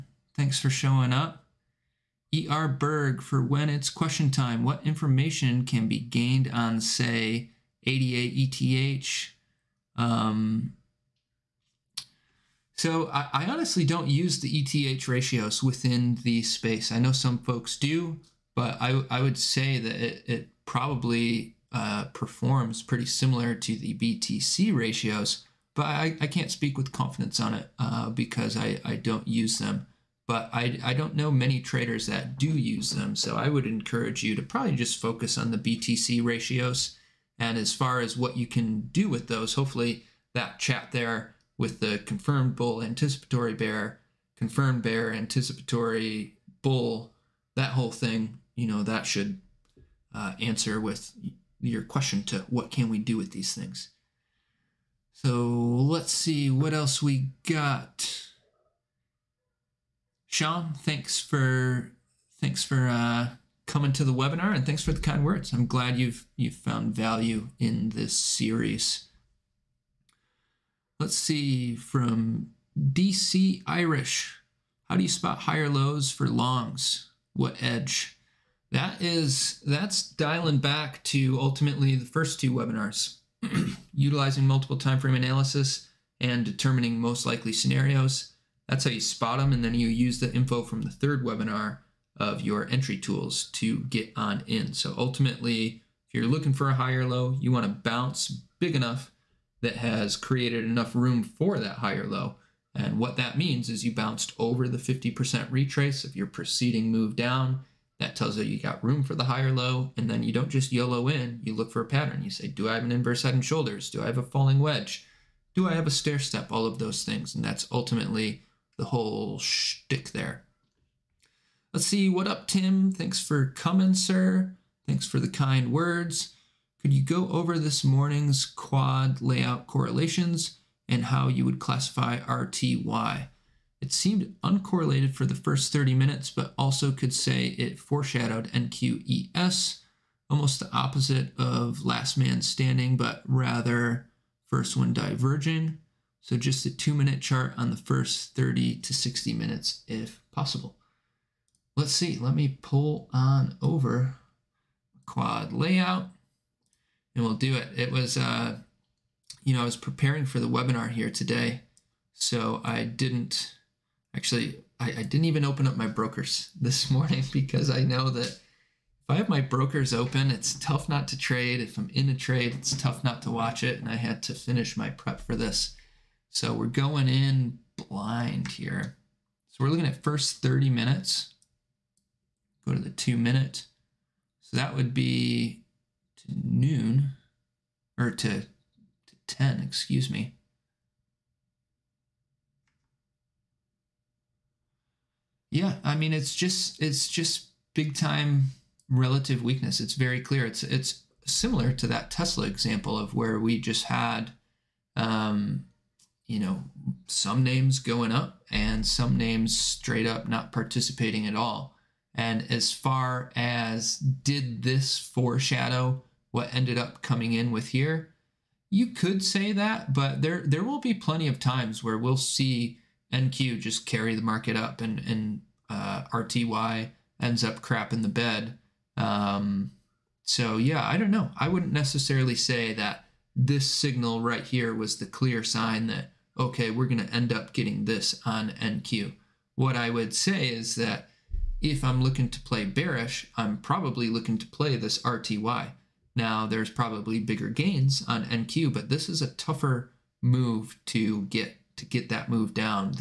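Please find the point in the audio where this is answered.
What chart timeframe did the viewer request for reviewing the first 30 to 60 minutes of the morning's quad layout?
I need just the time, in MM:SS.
02:26.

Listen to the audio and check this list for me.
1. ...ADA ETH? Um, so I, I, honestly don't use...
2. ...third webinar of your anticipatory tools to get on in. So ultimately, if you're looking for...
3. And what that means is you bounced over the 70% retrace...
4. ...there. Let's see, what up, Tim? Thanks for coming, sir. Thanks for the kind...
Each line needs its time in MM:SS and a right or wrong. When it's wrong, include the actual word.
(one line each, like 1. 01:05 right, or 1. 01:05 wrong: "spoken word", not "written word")
1. 00:07 right
2. 01:30 wrong: "entry", not "anticipatory"
3. 01:42 wrong: "50", not "70"
4. 02:00 right.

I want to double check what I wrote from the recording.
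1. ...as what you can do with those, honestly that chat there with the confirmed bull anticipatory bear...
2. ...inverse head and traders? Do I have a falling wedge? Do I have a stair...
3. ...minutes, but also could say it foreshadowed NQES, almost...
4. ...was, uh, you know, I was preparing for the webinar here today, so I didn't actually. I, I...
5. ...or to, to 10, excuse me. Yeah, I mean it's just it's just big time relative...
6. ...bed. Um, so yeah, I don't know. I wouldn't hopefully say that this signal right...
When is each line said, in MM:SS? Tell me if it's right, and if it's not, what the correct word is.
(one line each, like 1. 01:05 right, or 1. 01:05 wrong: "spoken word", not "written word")
1. 00:37 wrong: "hopefully", not "honestly"
2. 01:52 wrong: "shoulders", not "traders"
3. 02:15 right
4. 02:37 right
5. 03:07 right
6. 03:48 wrong: "necessarily", not "hopefully".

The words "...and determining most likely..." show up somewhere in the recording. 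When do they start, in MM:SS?
01:26.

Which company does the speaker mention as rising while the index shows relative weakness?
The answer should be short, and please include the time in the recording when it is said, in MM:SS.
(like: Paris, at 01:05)
Tesla, at 03:22.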